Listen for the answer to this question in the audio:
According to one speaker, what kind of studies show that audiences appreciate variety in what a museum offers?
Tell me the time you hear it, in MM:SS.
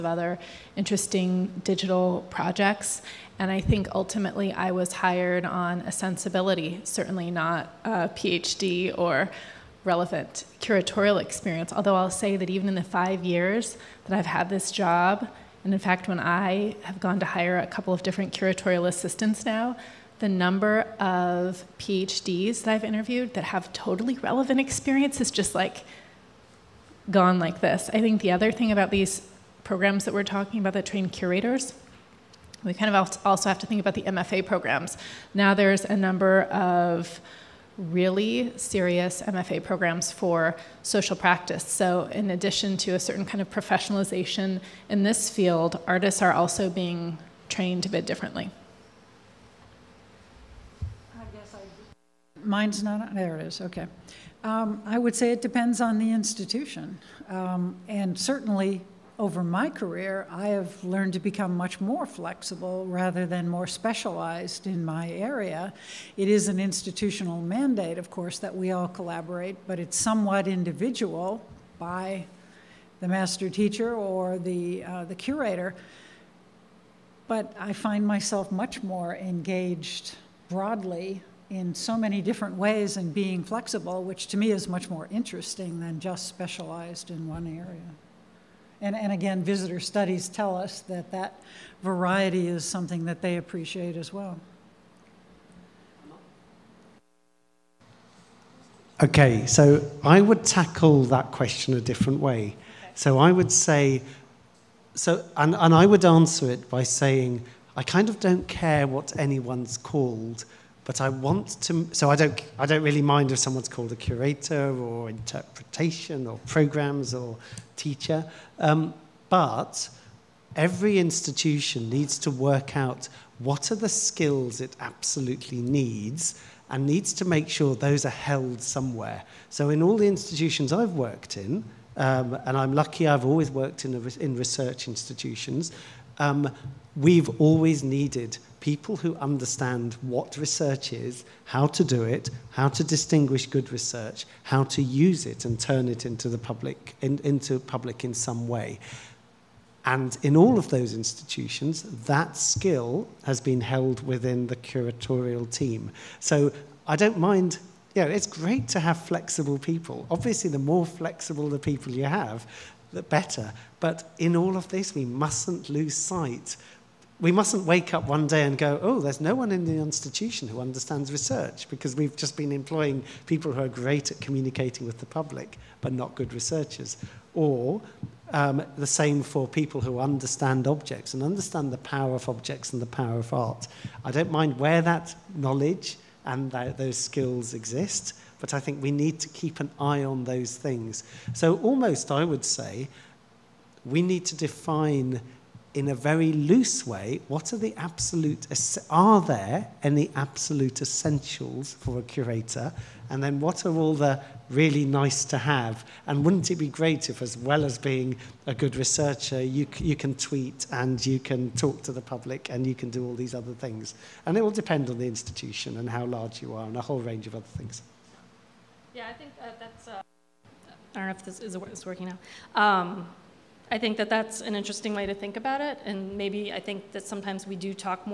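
01:29.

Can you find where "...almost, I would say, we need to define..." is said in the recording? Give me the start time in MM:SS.
03:11.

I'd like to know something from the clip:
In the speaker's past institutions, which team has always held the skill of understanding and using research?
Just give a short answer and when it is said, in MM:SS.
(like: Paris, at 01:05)
The curatorial team, at 02:34.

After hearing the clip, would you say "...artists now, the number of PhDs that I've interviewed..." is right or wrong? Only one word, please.
wrong.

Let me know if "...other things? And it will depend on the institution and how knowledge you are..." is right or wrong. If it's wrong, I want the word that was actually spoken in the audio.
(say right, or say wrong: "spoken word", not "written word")
wrong: "large", not "knowledge".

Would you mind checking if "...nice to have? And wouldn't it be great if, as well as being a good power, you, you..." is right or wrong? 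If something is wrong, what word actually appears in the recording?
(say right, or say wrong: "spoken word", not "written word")
wrong: "researcher", not "power".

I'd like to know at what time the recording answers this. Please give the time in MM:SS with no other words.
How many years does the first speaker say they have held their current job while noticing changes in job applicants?
00:12.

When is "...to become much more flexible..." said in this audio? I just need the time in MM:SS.
01:01.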